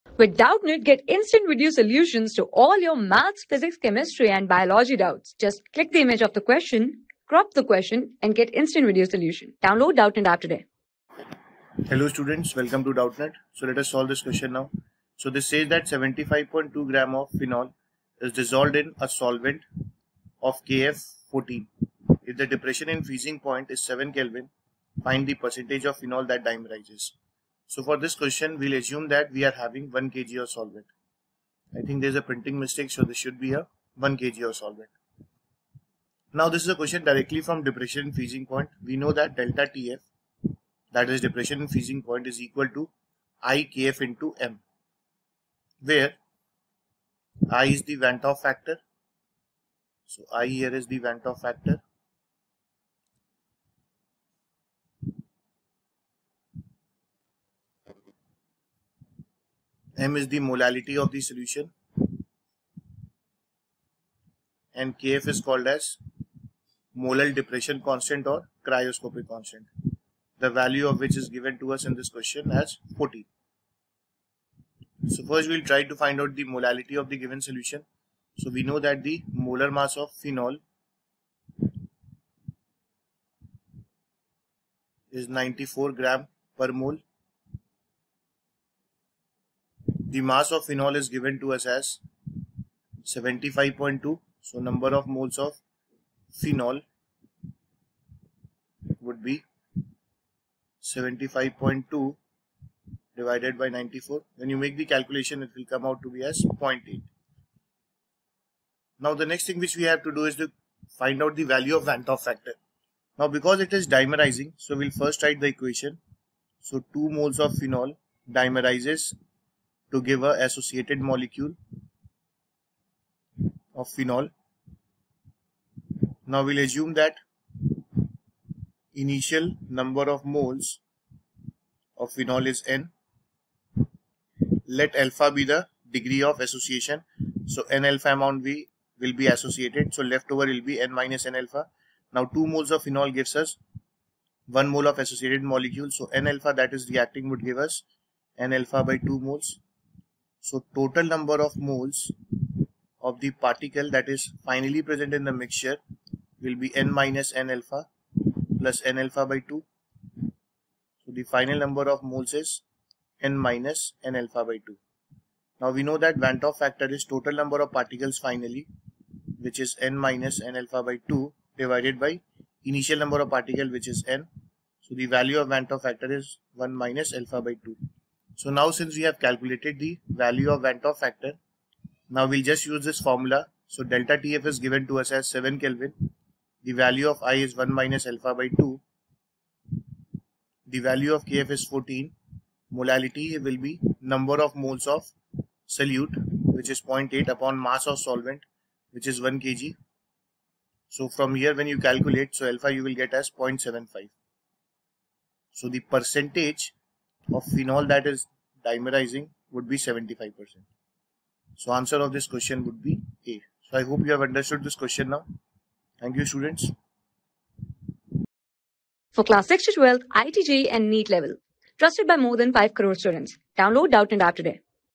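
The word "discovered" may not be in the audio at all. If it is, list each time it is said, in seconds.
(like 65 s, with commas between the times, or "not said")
not said.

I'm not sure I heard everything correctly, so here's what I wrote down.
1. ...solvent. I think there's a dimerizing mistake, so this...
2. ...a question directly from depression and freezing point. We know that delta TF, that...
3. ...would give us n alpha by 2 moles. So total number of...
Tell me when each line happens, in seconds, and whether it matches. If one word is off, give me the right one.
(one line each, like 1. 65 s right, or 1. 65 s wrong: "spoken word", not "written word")
1. 30 s wrong: "printing", not "dimerizing"
2. 36 s right
3. 147 s right.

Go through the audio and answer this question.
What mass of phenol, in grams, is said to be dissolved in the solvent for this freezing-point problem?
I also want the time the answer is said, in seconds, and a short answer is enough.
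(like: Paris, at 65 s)
75.2 grams, at 15 s.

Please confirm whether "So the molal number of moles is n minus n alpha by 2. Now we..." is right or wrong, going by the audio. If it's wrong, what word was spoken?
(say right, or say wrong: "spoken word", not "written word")
wrong: "final", not "molal".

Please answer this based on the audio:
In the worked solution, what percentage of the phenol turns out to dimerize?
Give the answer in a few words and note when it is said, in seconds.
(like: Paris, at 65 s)
75%, at 209 s.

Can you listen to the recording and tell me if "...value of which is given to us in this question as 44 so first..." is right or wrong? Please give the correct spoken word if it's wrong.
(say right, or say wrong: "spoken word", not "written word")
wrong: "40", not "44".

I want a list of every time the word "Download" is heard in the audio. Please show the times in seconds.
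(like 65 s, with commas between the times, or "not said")
9 s, 223 s.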